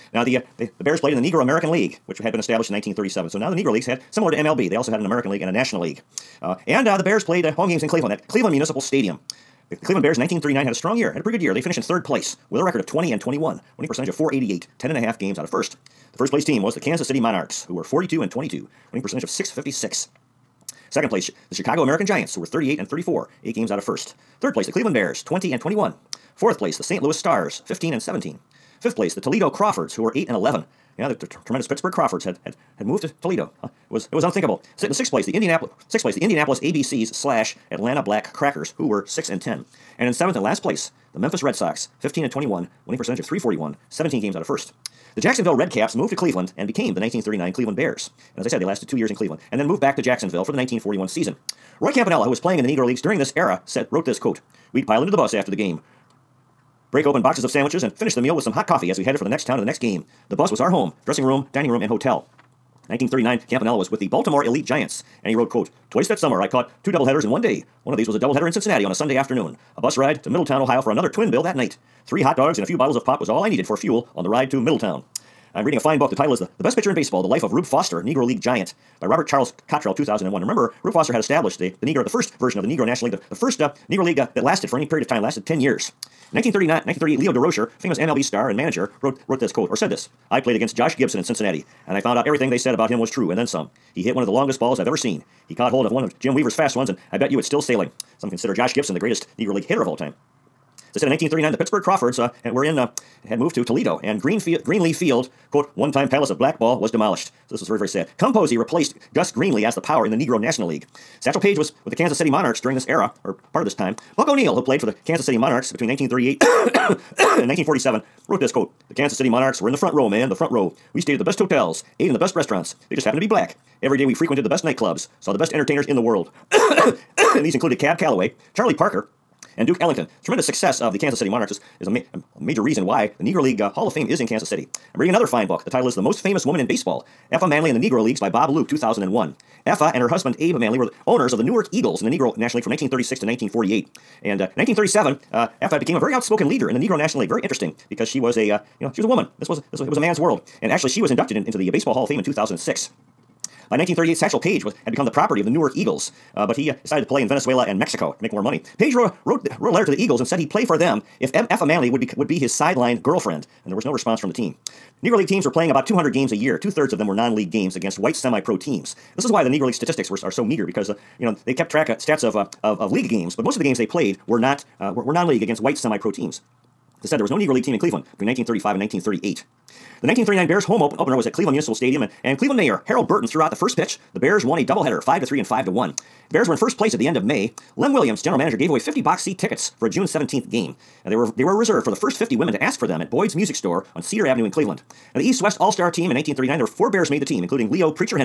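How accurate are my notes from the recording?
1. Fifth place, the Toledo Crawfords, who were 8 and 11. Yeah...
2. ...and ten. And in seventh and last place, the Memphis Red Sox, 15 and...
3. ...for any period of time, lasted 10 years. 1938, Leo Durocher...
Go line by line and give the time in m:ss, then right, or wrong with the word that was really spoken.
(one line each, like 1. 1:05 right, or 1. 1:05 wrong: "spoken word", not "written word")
1. 0:28 right
2. 0:39 right
3. 1:24 right.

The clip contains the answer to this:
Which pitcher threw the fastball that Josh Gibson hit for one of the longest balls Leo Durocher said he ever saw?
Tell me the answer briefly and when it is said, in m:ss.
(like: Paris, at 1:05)
Jim Weaver, at 1:36.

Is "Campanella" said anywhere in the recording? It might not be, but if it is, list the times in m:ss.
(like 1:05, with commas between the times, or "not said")
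0:51, 1:03.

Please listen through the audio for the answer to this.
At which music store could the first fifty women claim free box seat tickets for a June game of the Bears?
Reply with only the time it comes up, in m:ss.
3:13.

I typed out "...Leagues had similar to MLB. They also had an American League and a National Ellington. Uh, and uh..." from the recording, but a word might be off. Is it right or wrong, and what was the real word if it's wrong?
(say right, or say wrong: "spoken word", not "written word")
wrong: "League", not "Ellington".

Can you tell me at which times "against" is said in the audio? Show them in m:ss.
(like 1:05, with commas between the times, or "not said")
1:30, 2:47, 2:55.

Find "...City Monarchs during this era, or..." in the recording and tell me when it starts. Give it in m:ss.
1:52.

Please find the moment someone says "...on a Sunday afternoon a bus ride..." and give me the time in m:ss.
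1:08.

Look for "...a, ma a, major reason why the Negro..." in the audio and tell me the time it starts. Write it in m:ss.
2:11.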